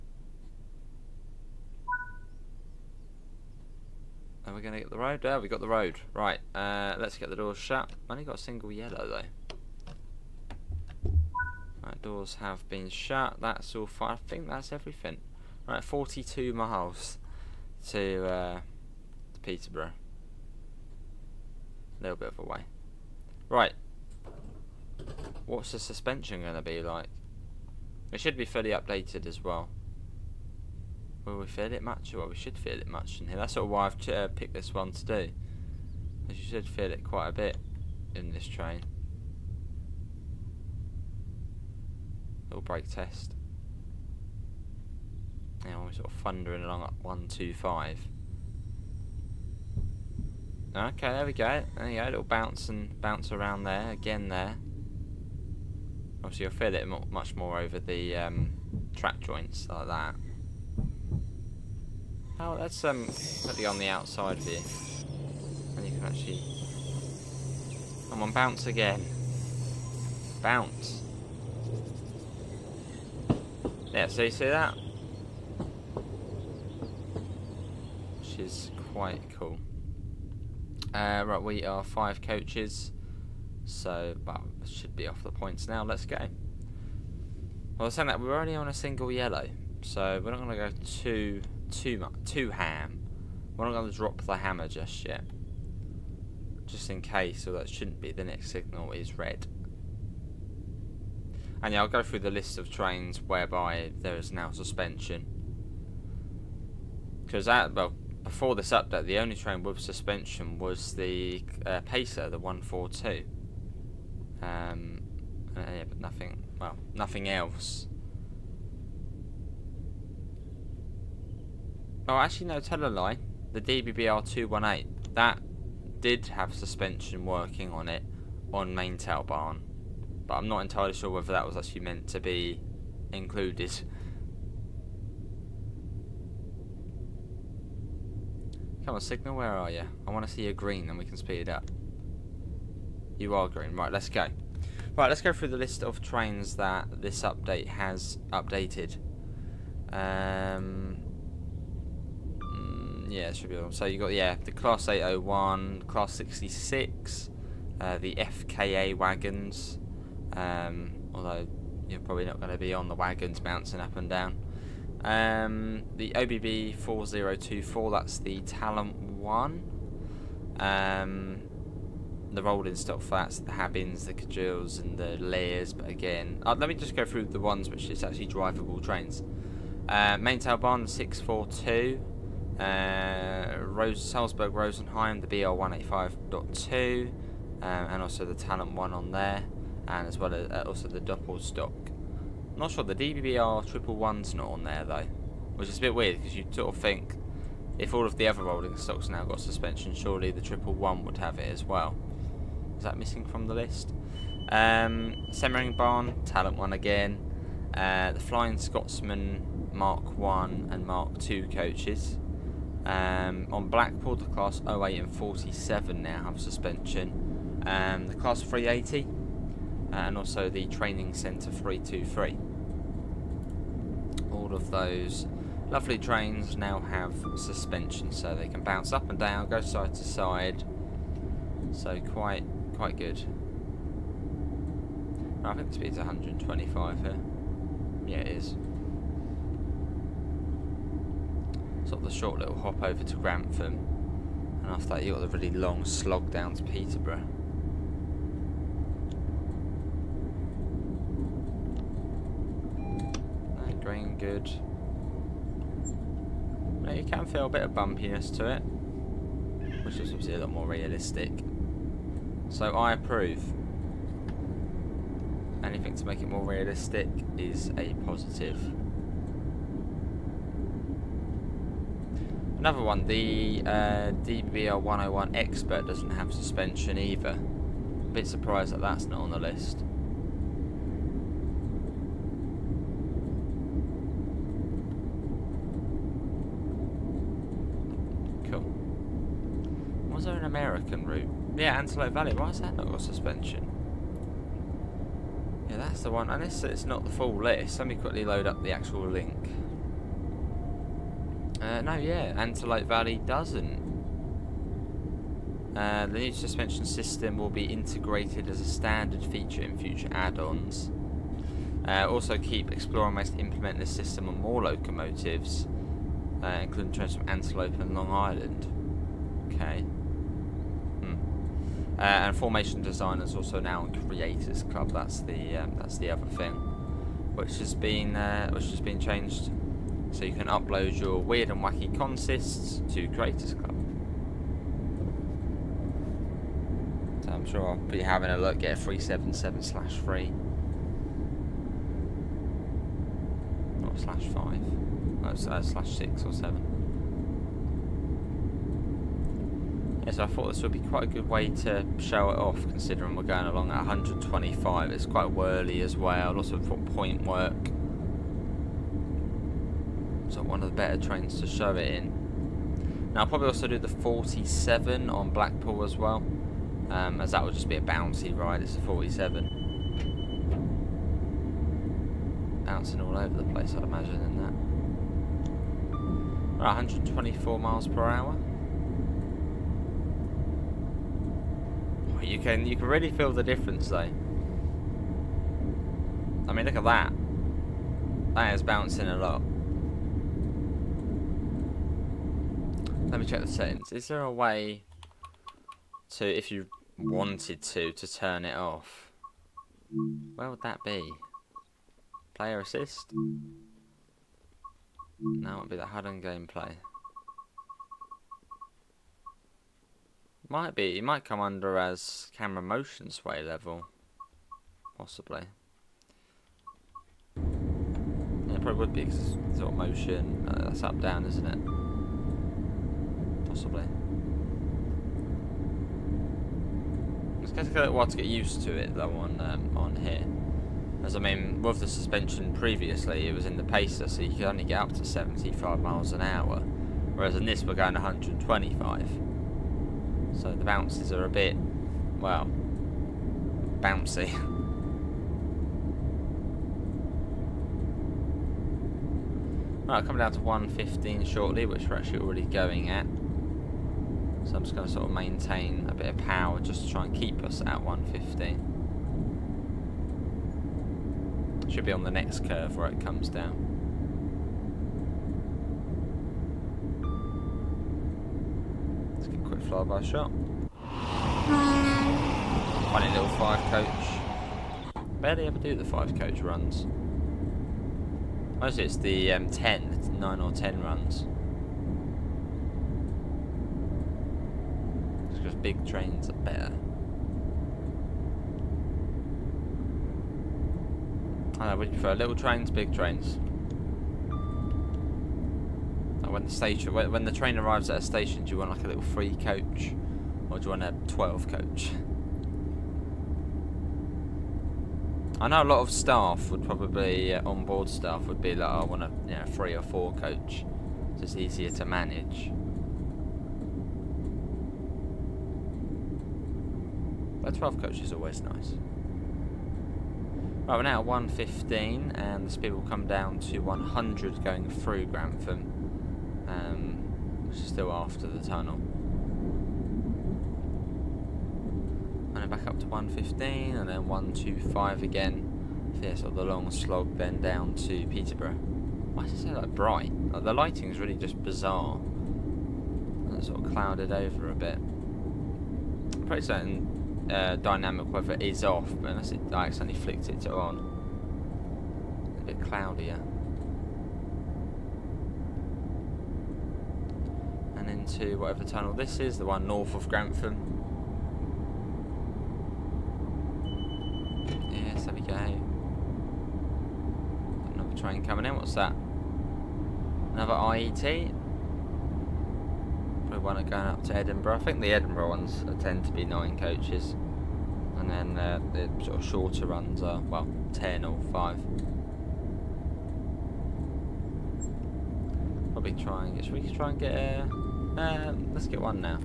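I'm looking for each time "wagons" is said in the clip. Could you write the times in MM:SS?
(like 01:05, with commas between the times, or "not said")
02:38, 02:42.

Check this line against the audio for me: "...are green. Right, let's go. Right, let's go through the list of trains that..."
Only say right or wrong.
right.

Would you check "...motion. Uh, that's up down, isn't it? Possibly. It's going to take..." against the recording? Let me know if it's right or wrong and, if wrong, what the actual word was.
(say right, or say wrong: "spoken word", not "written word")
right.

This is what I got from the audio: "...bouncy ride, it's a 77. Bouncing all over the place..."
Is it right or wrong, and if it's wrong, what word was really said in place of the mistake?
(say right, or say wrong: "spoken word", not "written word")
wrong: "47", not "77".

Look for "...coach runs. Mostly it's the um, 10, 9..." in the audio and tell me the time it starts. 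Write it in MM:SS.
07:56.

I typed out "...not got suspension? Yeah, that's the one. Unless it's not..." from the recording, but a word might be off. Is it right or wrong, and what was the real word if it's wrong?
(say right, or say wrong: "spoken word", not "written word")
right.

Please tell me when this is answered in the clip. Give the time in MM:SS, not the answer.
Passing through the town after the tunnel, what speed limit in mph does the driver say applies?
08:43.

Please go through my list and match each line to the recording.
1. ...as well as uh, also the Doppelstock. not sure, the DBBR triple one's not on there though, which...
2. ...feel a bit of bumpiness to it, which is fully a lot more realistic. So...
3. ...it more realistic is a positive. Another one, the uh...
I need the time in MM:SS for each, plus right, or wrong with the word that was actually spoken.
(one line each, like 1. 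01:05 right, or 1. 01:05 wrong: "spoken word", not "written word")
1. 03:10 right
2. 04:17 wrong: "obviously", not "fully"
3. 04:26 right.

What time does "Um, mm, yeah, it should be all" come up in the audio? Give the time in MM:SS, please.
02:29.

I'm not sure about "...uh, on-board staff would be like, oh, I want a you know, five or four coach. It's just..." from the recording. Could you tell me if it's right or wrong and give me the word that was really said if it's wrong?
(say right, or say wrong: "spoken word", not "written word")
wrong: "three", not "five".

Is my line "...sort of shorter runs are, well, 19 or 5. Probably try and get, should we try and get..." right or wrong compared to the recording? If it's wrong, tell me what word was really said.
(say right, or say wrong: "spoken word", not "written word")
wrong: "10", not "19".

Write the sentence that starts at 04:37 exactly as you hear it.
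A bit surprised that that's not on the list.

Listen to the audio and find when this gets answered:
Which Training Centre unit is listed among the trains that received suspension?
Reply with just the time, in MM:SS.
03:41.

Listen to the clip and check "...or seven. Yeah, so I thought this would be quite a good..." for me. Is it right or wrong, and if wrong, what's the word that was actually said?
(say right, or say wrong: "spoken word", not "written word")
right.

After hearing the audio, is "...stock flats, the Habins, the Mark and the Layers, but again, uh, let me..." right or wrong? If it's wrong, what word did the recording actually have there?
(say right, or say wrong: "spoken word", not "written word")
wrong: "Cajules", not "Mark".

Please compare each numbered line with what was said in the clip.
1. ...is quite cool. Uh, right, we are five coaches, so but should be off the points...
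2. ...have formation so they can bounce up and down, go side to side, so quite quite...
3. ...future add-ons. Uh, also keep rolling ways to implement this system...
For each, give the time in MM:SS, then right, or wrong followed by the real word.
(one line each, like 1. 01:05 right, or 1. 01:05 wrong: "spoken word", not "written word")
1. 01:18 right
2. 03:46 wrong: "suspension", not "formation"
3. 05:09 wrong: "exploring", not "rolling".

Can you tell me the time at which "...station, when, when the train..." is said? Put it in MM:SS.
08:16.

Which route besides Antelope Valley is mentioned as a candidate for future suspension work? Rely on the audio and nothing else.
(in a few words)
Long Island.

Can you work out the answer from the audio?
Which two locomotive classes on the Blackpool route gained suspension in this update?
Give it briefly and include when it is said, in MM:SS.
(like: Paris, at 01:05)
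Class 08 and 47, at 03:34.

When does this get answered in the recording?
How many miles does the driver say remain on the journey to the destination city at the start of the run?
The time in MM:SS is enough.
00:15.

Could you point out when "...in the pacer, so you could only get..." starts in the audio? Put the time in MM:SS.
07:13.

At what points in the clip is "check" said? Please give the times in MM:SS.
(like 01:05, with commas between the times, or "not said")
06:33.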